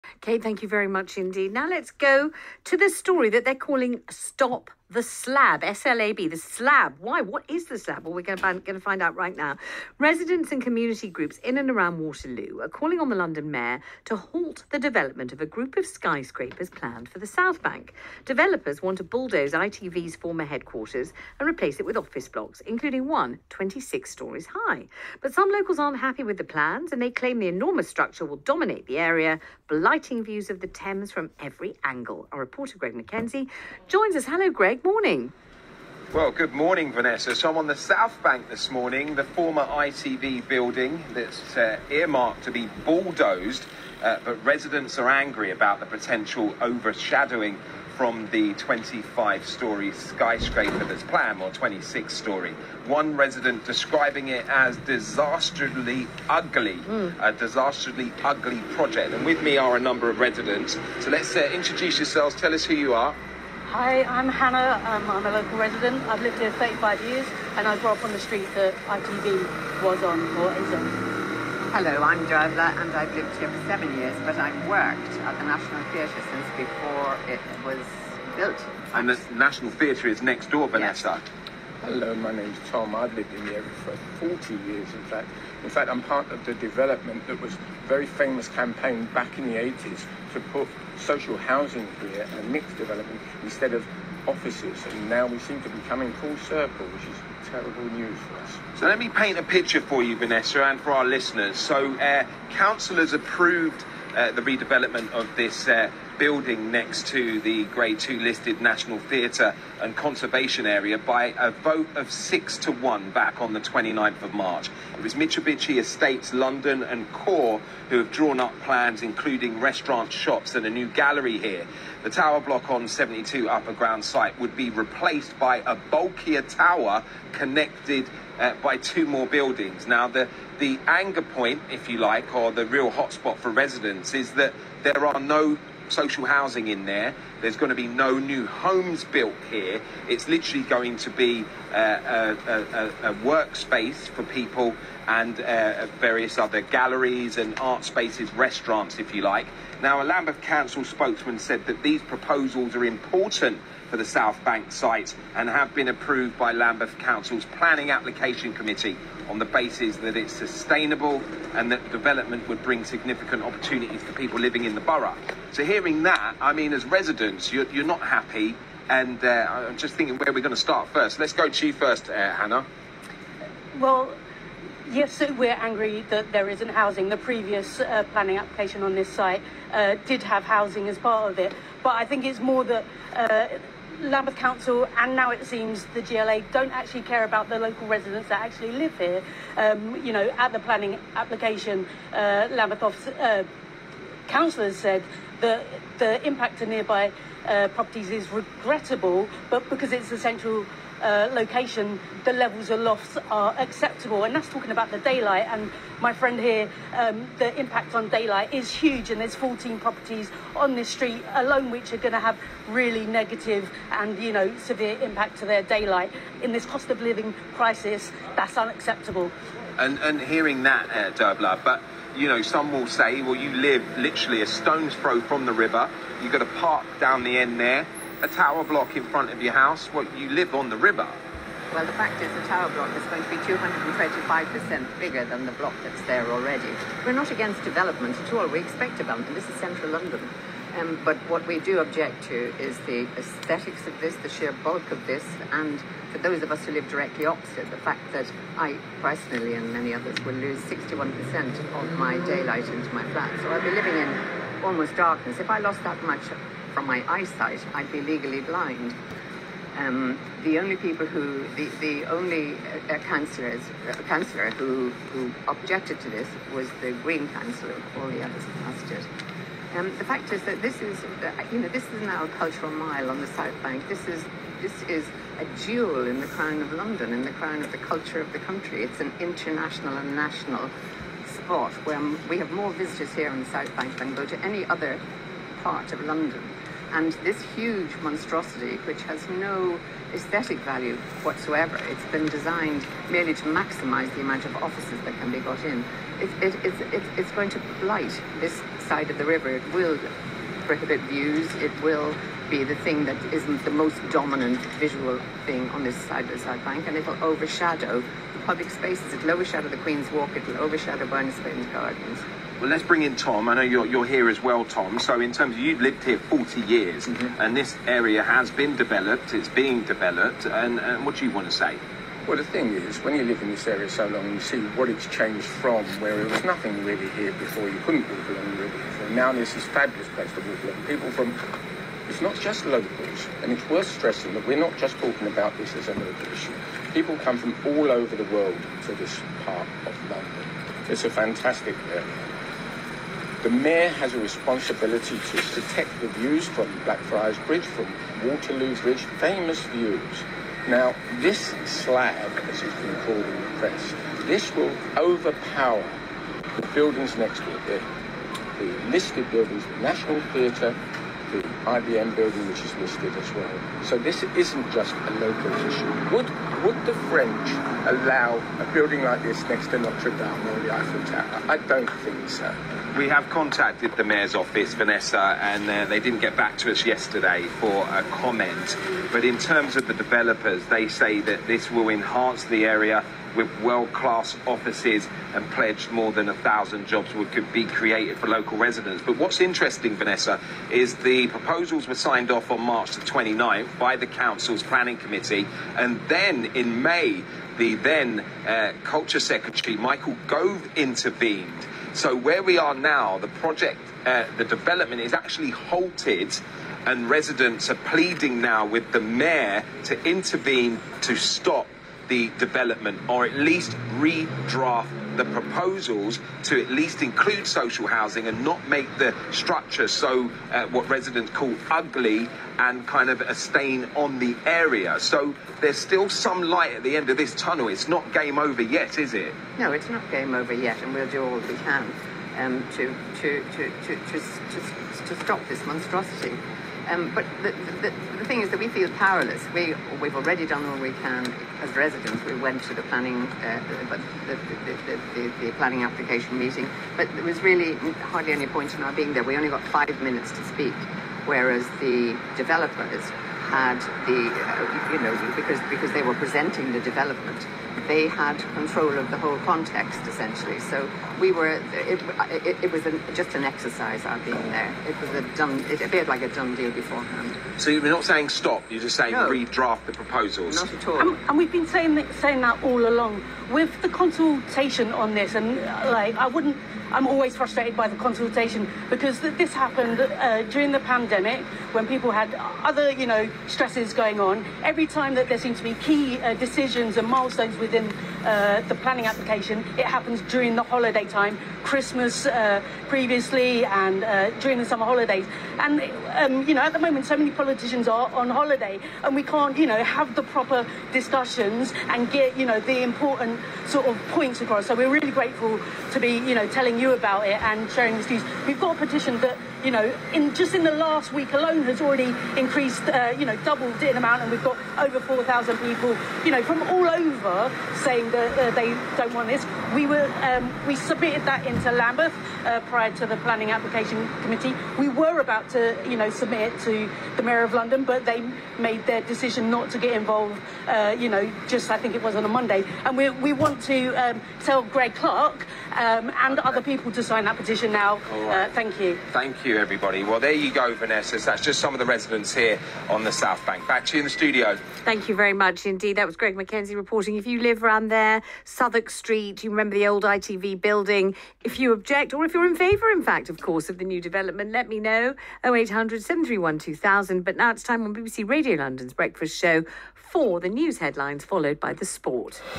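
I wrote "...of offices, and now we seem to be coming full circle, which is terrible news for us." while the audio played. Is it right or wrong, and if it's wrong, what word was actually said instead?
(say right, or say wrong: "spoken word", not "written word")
right.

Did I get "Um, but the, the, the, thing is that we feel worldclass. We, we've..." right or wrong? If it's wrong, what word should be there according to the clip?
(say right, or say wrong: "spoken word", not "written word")
wrong: "powerless", not "worldclass".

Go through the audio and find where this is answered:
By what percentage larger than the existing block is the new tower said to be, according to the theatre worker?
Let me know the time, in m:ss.
3:53.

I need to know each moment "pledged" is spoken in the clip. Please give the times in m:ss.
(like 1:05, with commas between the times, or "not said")
6:25.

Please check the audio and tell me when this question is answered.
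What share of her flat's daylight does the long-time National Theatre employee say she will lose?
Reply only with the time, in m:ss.
4:10.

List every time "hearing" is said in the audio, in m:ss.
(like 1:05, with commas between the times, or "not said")
2:45, 3:40.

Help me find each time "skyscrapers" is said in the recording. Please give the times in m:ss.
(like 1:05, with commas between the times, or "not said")
0:15, 0:49.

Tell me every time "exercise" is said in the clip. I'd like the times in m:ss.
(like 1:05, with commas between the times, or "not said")
7:43.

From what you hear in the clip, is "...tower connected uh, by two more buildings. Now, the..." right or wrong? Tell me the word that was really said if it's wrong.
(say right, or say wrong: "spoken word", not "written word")
right.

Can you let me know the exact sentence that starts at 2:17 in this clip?
There's going to be no new homes built here.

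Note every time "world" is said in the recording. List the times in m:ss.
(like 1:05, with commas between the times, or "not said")
5:38, 6:23.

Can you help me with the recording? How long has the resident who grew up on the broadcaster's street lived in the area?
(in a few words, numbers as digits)
35 years.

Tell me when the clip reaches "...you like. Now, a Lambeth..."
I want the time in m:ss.
2:29.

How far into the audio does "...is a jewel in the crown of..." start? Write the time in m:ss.
4:34.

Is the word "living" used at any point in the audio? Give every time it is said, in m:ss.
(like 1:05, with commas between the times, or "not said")
2:44, 3:37, 4:13.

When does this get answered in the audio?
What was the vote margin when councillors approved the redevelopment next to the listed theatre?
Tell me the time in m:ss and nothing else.
1:52.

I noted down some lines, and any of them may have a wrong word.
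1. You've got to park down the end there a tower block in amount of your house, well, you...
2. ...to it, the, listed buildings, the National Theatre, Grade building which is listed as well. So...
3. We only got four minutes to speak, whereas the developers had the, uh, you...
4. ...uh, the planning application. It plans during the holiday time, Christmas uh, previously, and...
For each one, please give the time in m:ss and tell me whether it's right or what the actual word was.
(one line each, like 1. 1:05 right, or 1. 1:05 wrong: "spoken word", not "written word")
1. 3:46 wrong: "front", not "amount"
2. 5:57 wrong: "IBM", not "Grade"
3. 7:29 wrong: "five", not "four"
4. 8:08 wrong: "happens", not "plans".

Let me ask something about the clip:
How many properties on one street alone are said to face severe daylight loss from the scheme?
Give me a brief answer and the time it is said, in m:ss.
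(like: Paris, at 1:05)
14, at 3:29.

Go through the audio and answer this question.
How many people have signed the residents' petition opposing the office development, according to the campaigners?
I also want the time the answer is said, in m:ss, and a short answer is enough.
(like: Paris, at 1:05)
over 4,000, at 8:34.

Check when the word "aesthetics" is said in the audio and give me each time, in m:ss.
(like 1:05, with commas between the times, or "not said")
4:03, 4:50.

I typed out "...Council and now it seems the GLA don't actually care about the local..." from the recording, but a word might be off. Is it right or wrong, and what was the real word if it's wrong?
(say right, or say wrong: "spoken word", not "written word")
right.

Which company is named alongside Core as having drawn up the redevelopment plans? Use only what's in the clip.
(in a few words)
Mitsubishi Estates London.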